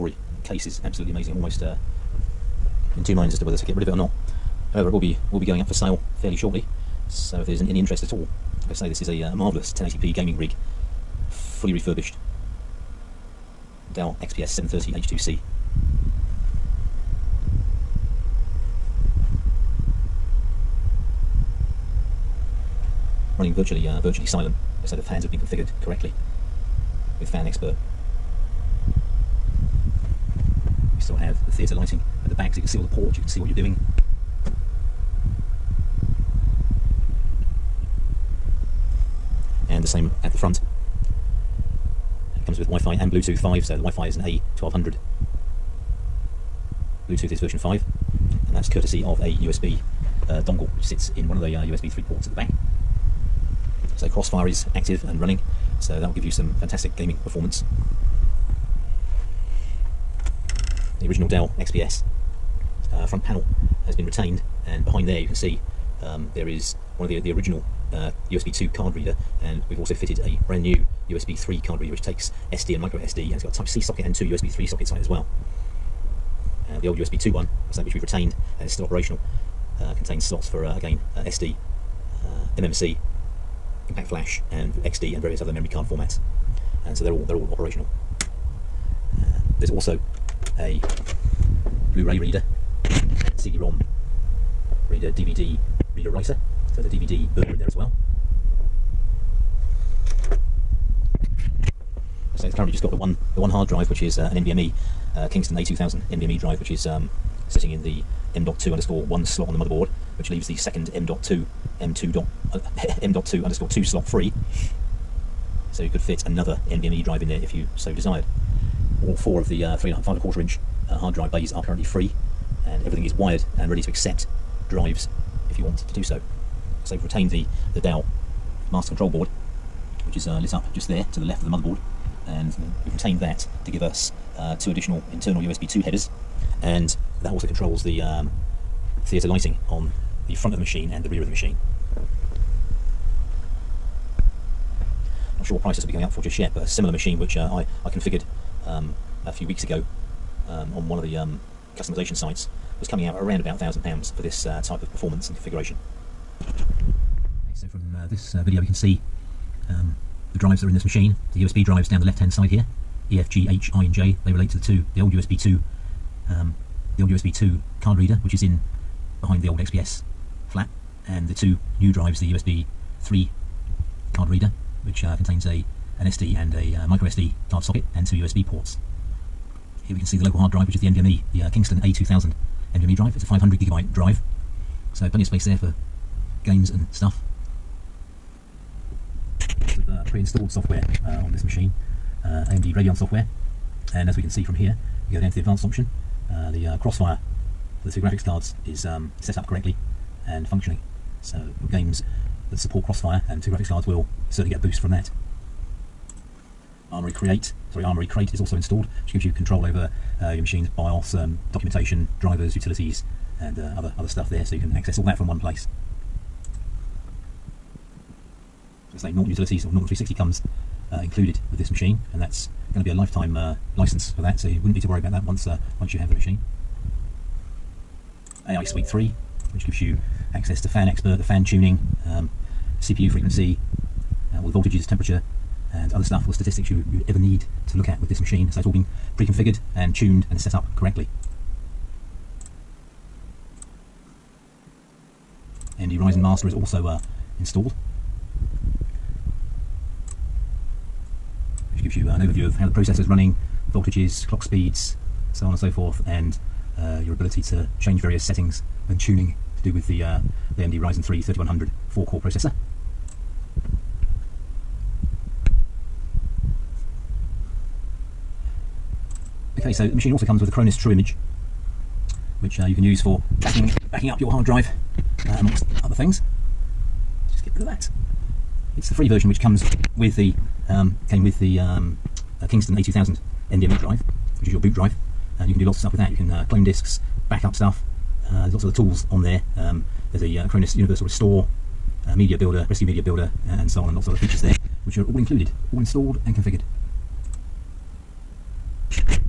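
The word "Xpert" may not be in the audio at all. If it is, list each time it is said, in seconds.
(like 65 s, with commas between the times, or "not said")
27 s, 230 s.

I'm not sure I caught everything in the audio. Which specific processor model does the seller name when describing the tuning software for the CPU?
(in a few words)
AMD Ryzen 3 3100.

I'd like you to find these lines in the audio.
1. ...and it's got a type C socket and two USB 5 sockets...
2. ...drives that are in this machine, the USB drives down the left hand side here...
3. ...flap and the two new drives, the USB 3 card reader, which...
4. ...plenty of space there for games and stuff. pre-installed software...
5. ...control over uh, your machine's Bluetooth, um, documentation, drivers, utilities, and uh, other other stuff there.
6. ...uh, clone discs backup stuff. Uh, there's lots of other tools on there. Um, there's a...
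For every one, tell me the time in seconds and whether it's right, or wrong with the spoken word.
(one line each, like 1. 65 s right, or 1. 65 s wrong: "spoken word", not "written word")
1. 73 s wrong: "3", not "5"
2. 160 s right
3. 170 s right
4. 185 s right
5. 209 s wrong: "BIOS", not "Bluetooth"
6. 286 s right.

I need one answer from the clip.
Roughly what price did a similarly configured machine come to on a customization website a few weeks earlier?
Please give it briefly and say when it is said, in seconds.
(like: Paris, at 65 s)
£1,000, at 153 s.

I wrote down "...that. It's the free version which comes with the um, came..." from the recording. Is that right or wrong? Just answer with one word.
right.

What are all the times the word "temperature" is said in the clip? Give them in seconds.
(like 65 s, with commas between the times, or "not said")
234 s.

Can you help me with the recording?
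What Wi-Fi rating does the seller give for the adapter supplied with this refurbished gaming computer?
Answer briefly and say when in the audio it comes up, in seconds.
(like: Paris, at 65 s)
A1200, at 44 s.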